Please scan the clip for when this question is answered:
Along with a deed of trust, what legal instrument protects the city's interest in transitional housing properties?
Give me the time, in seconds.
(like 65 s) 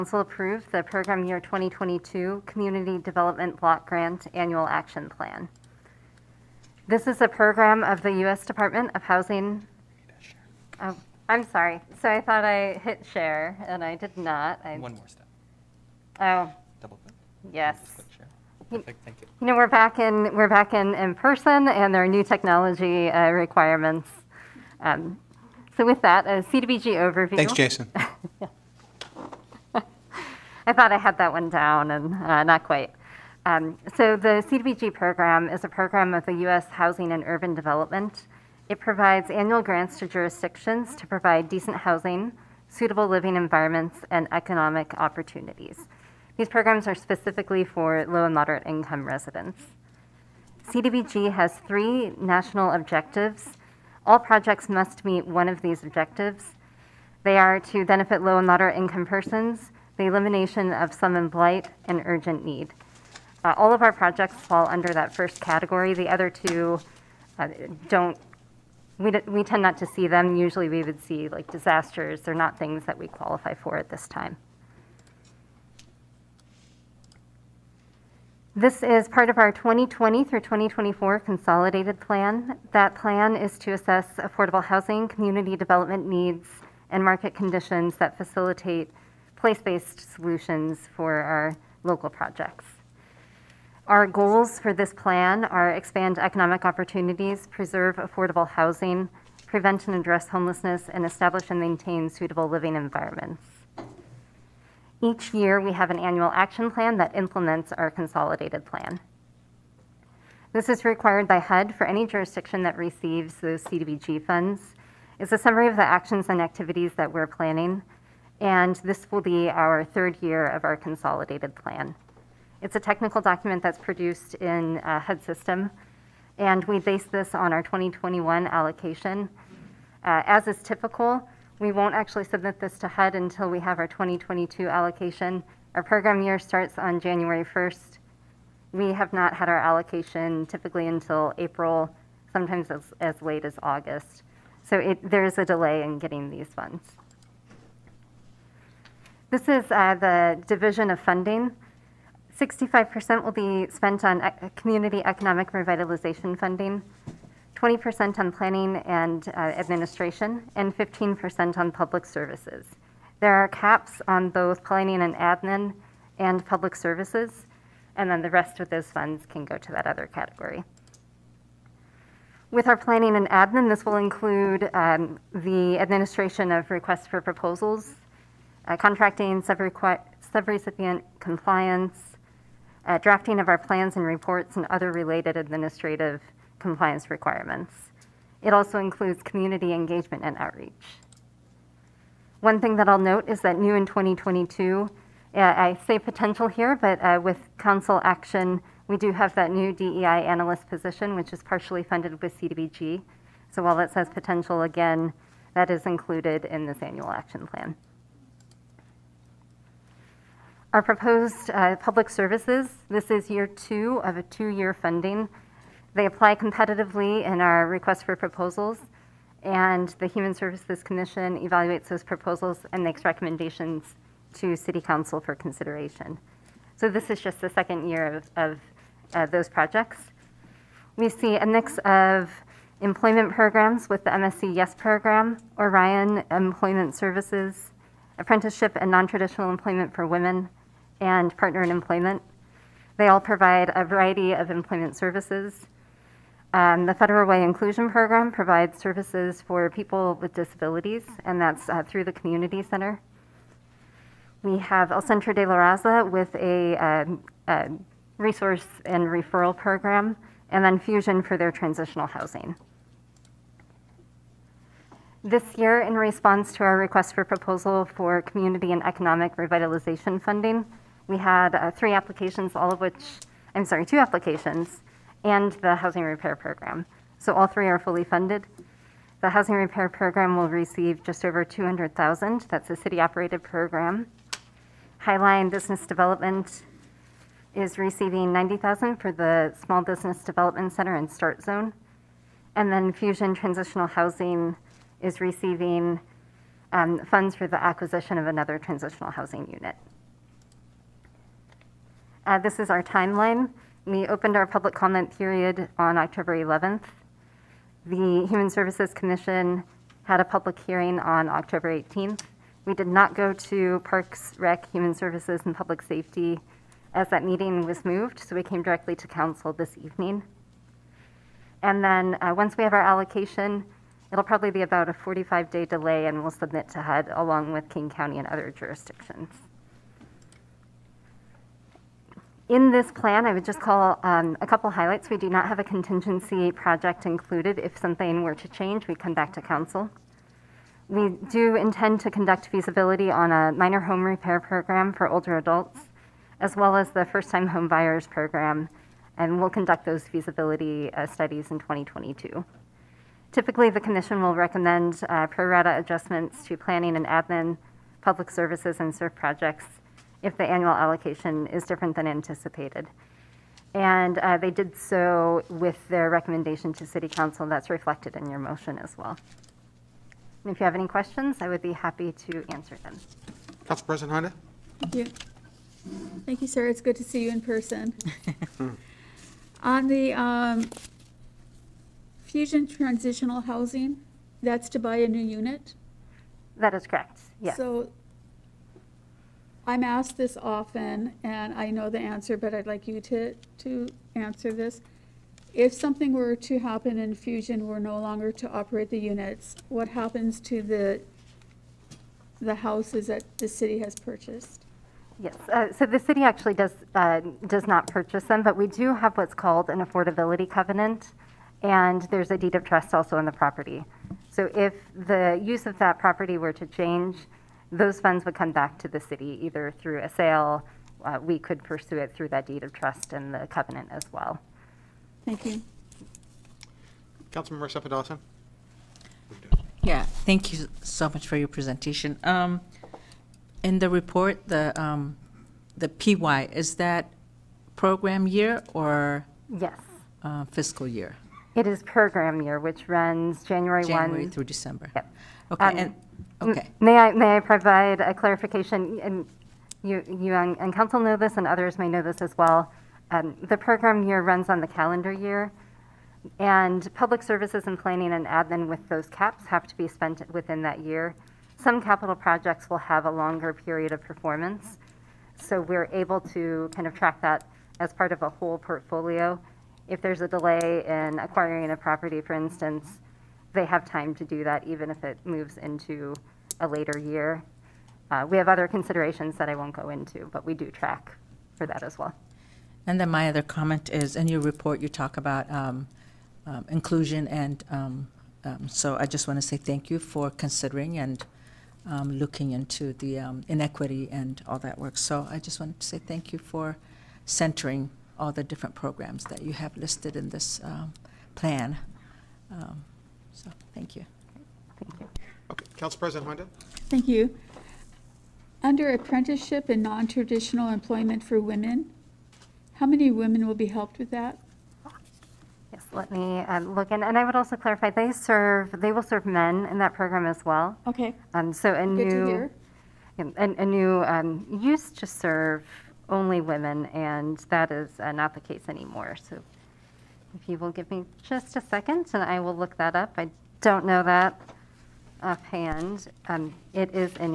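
409 s.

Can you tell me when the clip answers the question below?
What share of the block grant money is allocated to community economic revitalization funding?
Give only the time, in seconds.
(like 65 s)
152 s.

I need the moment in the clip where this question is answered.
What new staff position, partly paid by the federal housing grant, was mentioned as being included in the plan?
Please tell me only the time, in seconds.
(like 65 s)
199 s.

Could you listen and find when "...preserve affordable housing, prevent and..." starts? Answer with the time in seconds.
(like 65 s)
97 s.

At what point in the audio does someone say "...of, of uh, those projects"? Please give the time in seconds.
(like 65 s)
228 s.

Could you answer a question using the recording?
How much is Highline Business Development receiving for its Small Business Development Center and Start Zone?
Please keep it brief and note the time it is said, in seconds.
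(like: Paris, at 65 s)
90,000, at 288 s.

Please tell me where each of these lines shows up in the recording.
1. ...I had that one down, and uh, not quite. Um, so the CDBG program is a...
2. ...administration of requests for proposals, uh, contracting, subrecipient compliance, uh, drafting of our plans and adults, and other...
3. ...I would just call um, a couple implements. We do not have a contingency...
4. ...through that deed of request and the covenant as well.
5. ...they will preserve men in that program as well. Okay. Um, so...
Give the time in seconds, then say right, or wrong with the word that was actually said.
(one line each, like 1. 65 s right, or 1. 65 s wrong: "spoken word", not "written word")
1. 30 s right
2. 175 s wrong: "reports", not "adults"
3. 333 s wrong: "highlights", not "implements"
4. 422 s wrong: "trust", not "request"
5. 518 s wrong: "serve", not "preserve".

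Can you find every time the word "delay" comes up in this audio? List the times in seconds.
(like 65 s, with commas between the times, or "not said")
145 s, 325 s, 470 s.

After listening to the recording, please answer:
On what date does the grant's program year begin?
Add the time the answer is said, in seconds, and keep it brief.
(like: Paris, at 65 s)
January 1st, at 136 s.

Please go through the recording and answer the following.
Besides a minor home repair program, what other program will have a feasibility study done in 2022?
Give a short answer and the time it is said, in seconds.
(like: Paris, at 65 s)
first time home buyers program, at 347 s.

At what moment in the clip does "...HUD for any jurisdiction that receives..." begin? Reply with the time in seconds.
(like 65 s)
111 s.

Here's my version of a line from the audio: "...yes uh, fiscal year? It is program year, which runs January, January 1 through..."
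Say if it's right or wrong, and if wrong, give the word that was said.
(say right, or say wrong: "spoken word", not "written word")
right.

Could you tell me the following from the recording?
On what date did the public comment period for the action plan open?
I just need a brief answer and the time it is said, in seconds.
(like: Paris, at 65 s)
October 11th, at 305 s.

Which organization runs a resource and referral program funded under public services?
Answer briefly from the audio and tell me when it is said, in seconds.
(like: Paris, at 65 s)
El Centro de la Raza, at 254 s.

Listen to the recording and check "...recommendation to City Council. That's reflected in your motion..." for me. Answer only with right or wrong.
right.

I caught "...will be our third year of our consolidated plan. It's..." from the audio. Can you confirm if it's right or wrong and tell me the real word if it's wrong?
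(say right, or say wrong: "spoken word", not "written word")
right.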